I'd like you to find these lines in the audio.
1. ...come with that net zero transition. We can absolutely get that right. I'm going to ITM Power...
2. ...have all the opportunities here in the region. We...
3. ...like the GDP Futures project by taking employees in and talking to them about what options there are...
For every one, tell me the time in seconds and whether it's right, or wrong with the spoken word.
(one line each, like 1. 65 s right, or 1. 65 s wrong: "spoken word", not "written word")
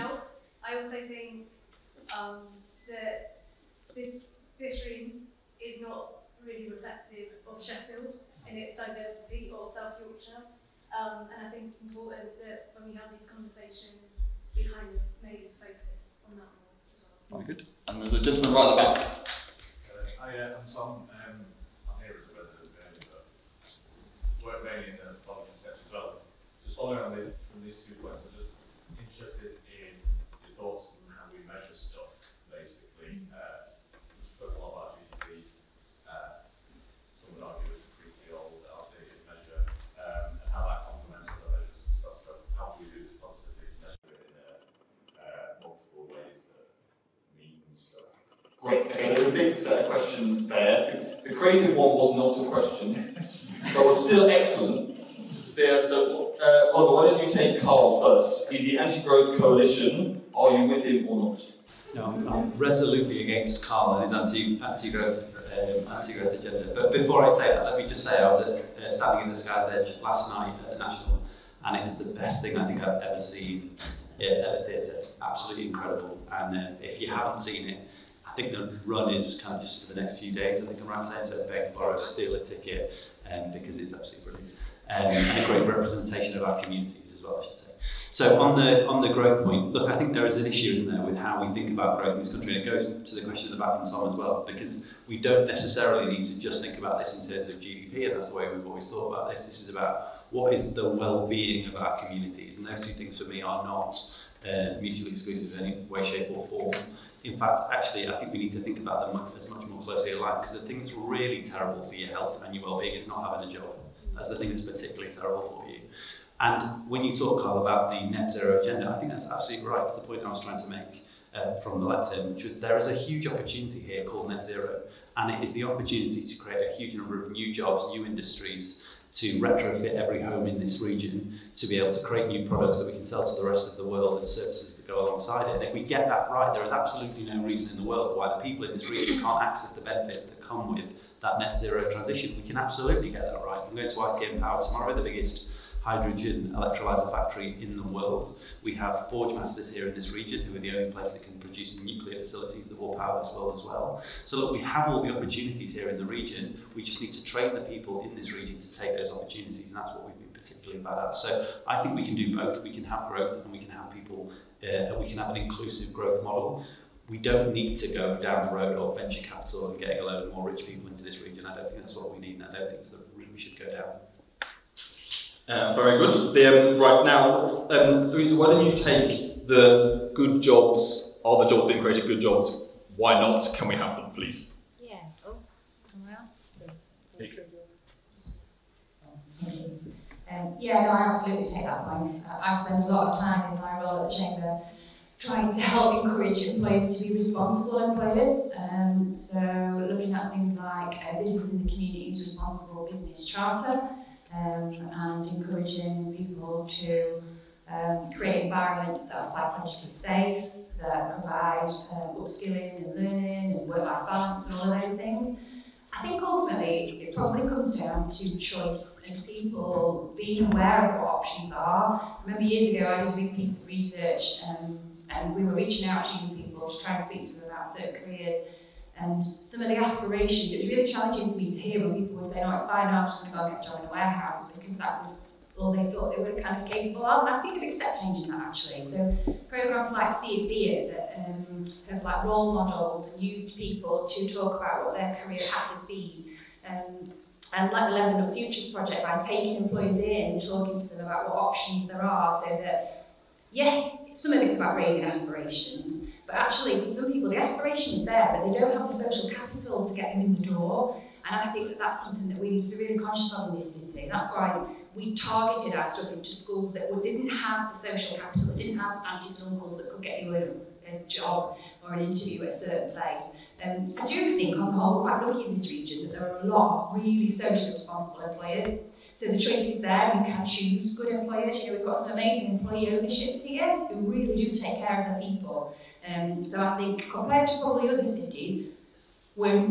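1. 140 s right
2. 154 s right
3. 247 s wrong: "Leathernut", not "GDP".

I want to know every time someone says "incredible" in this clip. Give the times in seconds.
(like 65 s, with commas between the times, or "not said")
75 s.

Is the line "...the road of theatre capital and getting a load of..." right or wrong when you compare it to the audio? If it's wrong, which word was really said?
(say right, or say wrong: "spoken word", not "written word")
wrong: "venture", not "theatre".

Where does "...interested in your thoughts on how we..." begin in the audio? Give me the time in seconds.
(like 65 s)
28 s.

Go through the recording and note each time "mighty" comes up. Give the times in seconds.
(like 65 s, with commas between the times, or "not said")
not said.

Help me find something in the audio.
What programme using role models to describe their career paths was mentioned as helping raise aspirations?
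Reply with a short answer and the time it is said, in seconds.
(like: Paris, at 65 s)
See It, Be It, at 240 s.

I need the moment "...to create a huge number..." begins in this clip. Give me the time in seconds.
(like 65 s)
126 s.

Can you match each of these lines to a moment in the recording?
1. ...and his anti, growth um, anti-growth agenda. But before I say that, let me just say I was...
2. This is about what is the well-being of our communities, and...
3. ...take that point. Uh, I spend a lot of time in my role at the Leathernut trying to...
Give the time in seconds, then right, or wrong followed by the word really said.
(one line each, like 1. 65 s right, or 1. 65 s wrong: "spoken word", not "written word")
1. 63 s right
2. 99 s right
3. 191 s wrong: "Chamber", not "Leathernut".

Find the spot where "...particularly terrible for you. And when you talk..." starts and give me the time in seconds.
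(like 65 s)
114 s.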